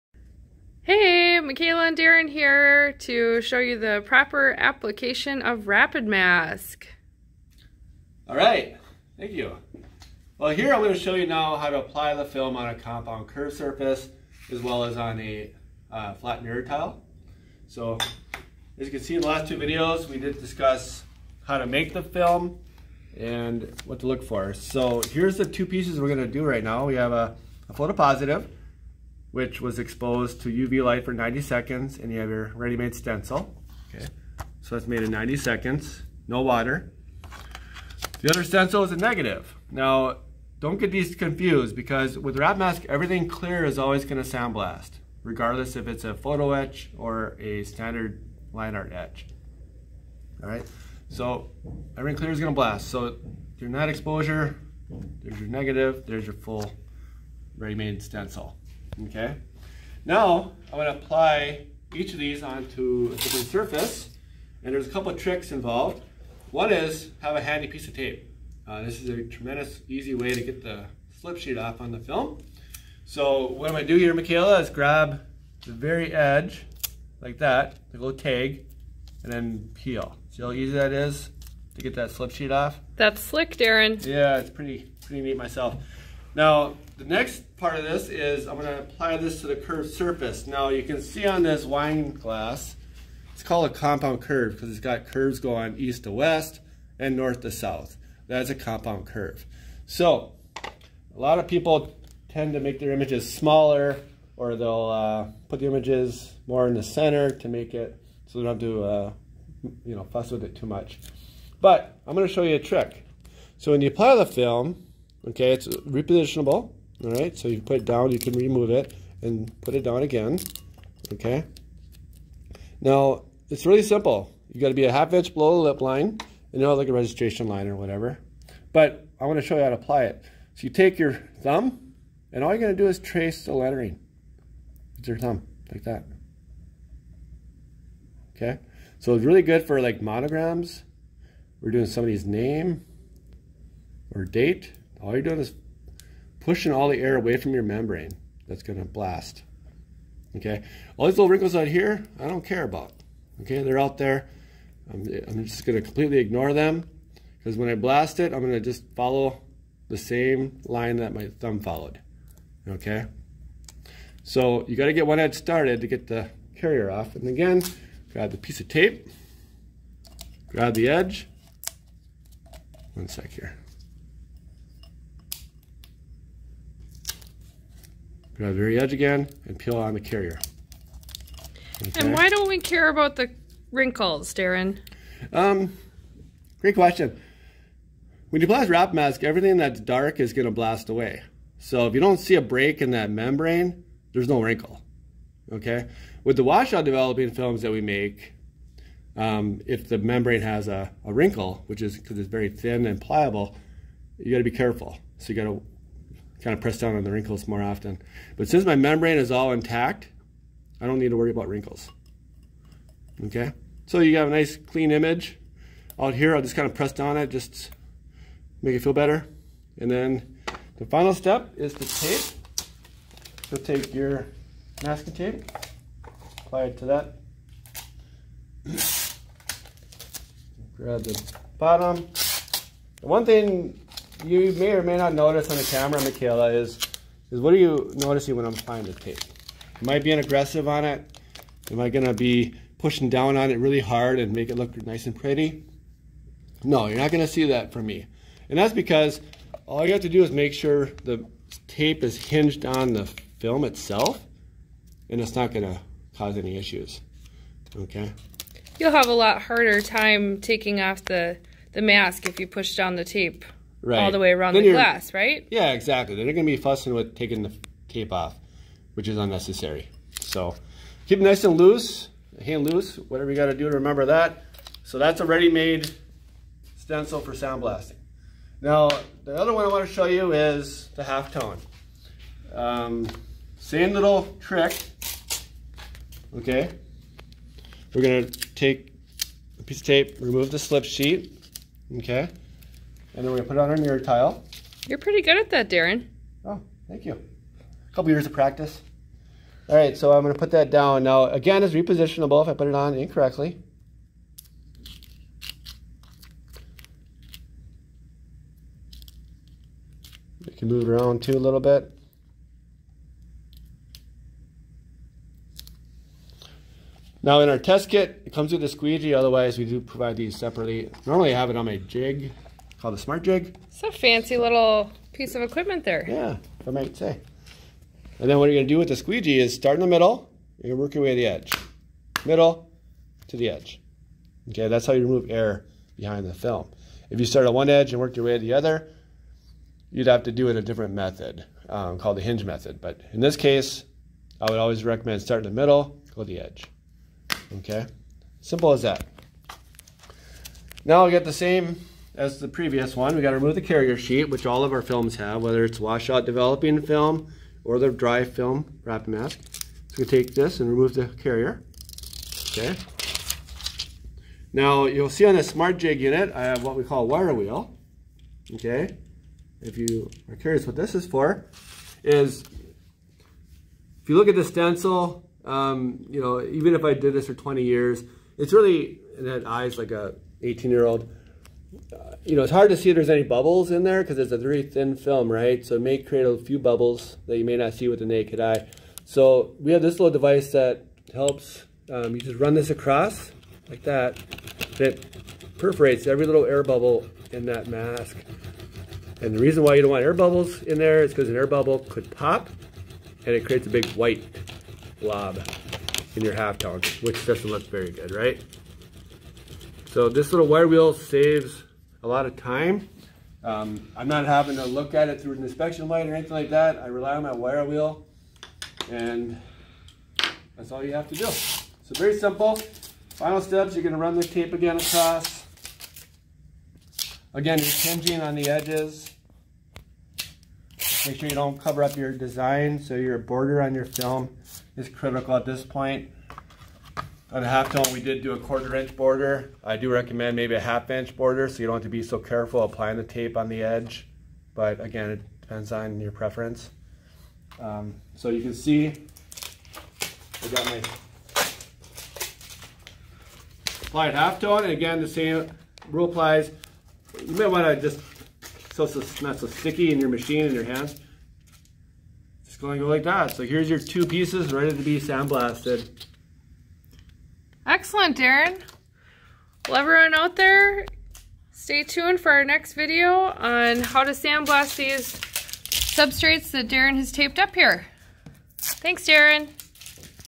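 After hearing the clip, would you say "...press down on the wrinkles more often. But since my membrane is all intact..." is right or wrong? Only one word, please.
right.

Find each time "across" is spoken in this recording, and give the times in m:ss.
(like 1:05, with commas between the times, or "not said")
6:32, 7:04.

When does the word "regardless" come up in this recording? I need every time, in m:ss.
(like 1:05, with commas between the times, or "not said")
0:45.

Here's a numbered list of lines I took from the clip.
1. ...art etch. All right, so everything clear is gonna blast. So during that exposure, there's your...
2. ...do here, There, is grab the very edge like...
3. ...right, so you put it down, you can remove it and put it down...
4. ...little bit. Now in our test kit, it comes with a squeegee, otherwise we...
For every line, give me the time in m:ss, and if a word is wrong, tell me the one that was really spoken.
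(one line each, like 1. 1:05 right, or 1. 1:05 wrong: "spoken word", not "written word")
1. 0:48 right
2. 1:13 wrong: "Michaela", not "There"
3. 1:57 right
4. 5:11 right.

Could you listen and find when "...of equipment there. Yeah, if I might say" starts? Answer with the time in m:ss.
5:25.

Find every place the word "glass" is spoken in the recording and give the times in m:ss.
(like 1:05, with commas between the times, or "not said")
1:32, 4:24.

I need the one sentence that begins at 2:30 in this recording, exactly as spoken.
Okay, all these little wrinkles out here, I don't care about.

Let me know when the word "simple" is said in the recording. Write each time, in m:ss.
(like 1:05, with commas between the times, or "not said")
2:03, 5:48, 7:02.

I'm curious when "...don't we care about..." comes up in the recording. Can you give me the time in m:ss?
3:02.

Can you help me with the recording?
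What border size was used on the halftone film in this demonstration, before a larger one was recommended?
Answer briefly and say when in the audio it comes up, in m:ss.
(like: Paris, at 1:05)
quarter inch, at 7:18.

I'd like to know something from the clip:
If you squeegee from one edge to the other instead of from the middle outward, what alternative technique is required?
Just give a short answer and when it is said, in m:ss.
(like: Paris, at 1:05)
hinge method, at 5:42.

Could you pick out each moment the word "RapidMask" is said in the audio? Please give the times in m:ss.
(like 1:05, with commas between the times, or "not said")
0:05, 5:58.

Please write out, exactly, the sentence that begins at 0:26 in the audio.
We have a, a photopositive which was exposed to UV light for 90 seconds, and you have your ready-made stencil.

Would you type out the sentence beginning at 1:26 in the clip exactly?
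Now, the next part of this is I'm going to apply this to the curved surface.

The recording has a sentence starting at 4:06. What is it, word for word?
No, you're not gonna see that from me.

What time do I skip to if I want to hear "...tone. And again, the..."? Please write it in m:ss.
7:34.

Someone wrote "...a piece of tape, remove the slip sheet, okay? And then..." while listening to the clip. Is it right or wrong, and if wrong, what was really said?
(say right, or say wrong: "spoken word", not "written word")
right.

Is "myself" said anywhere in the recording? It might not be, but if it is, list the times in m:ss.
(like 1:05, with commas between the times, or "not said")
1:25.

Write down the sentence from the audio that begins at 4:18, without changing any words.
You'll have a lot harder time taking off the, the mask if you push down the tape right.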